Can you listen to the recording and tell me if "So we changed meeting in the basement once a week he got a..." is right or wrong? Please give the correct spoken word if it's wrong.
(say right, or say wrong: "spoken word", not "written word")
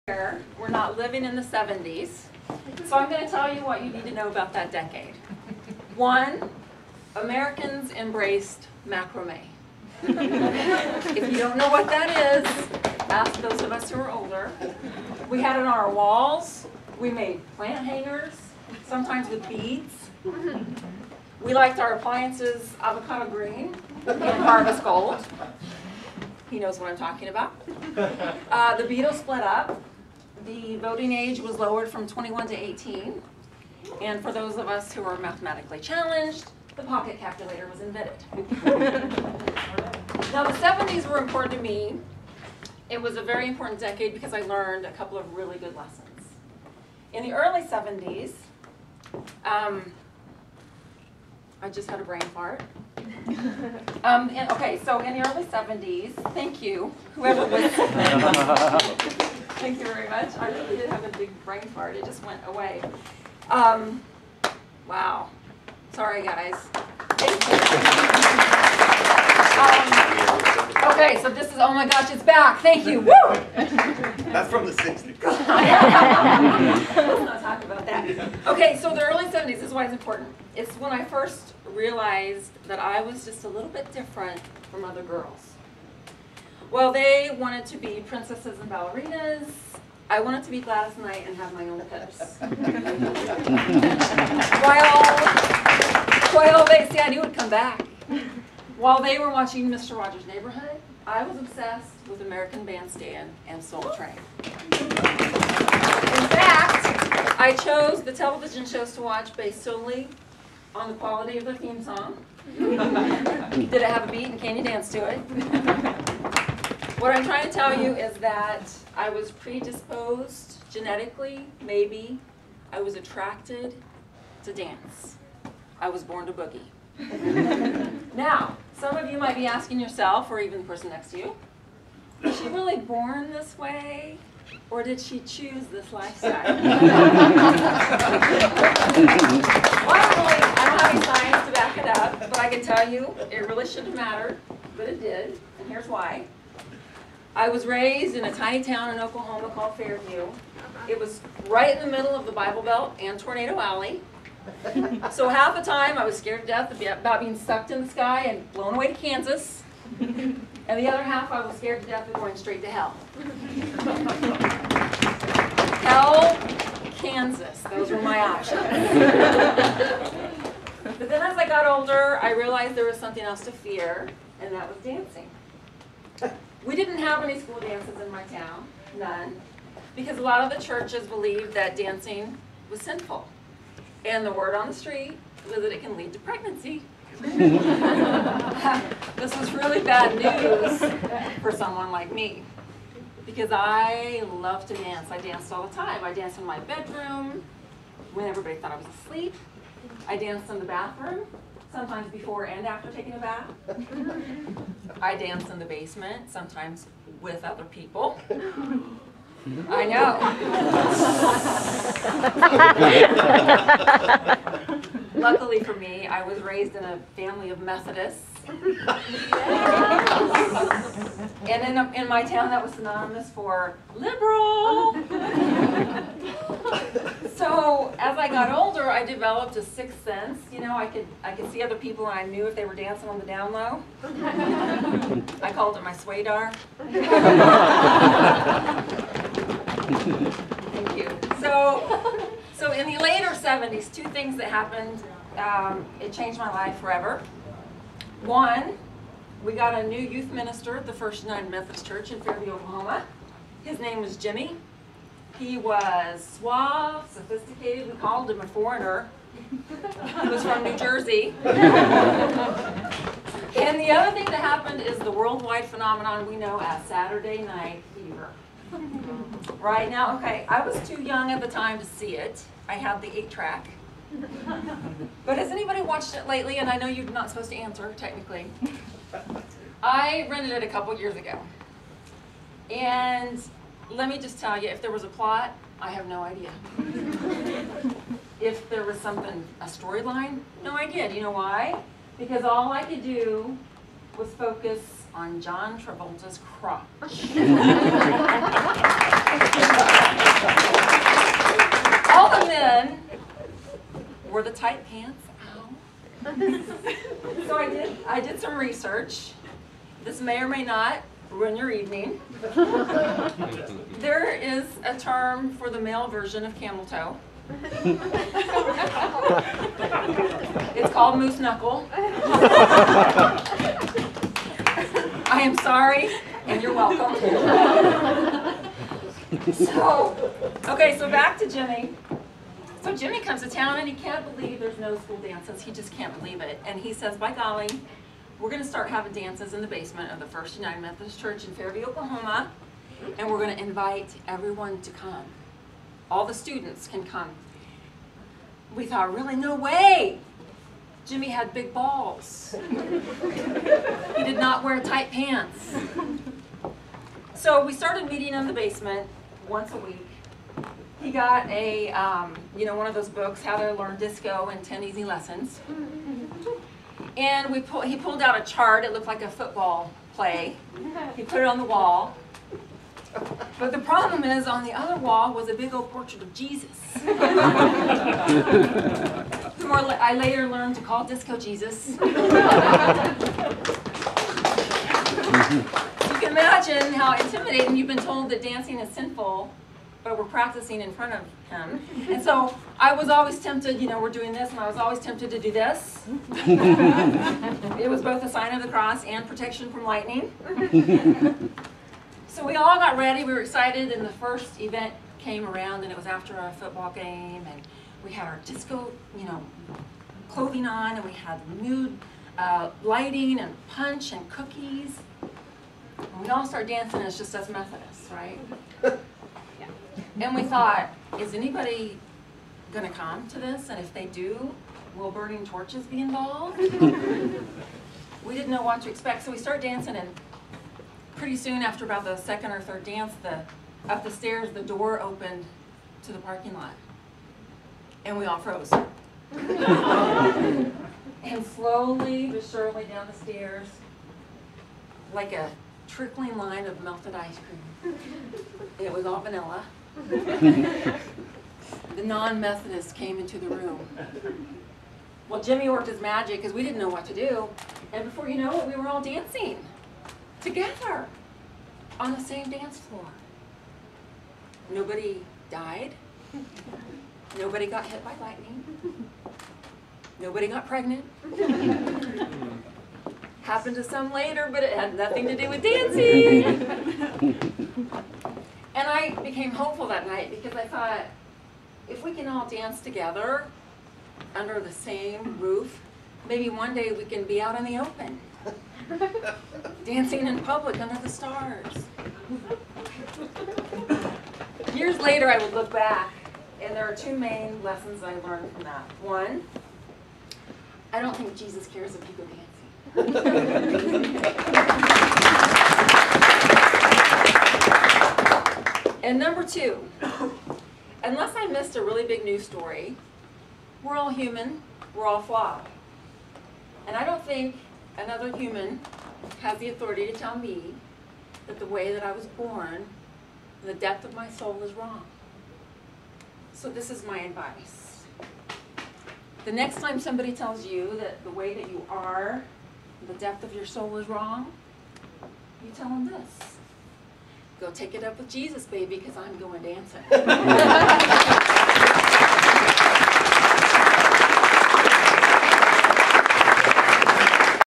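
wrong: "started", not "changed".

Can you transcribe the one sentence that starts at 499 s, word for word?
One, I don't think Jesus cares if you go dancing.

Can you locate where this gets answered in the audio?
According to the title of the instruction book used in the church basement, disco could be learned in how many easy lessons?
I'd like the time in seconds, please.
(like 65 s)
364 s.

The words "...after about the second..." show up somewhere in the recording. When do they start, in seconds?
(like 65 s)
431 s.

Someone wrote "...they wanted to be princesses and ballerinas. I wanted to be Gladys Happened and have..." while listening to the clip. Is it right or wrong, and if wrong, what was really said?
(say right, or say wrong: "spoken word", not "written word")
wrong: "Knight", not "Happened".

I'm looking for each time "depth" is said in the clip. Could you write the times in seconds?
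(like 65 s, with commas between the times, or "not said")
523 s, 533 s.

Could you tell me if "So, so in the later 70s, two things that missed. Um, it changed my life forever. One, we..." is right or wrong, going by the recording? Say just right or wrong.
wrong.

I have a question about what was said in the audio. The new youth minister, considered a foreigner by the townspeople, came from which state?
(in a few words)
New Jersey.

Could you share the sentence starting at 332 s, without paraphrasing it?
So Jimmy comes to town and he can't believe there's no school dances.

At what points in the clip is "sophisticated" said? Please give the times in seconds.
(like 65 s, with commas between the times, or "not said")
257 s.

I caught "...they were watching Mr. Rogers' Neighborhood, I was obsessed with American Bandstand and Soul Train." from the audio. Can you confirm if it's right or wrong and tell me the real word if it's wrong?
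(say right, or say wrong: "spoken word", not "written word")
right.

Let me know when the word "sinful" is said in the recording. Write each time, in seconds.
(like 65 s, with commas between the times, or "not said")
182 s, 388 s.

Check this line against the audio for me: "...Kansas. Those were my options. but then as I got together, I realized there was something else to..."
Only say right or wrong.
wrong.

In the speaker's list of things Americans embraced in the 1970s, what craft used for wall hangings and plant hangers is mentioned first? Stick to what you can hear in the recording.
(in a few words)
Macrame.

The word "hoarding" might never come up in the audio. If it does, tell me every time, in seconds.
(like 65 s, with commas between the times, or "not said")
not said.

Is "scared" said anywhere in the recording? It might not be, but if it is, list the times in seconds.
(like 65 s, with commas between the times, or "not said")
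156 s, 161 s.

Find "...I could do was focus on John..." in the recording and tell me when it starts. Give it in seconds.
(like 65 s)
292 s.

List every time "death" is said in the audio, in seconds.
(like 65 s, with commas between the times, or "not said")
156 s, 161 s.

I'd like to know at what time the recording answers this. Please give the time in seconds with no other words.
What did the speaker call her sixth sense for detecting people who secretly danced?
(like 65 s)
235 s.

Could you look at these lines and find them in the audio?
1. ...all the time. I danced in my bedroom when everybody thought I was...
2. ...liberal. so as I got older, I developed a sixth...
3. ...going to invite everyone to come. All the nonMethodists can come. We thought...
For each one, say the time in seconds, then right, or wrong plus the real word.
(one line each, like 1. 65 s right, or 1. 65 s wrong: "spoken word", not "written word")
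1. 195 s right
2. 223 s right
3. 343 s wrong: "students", not "nonMethodists".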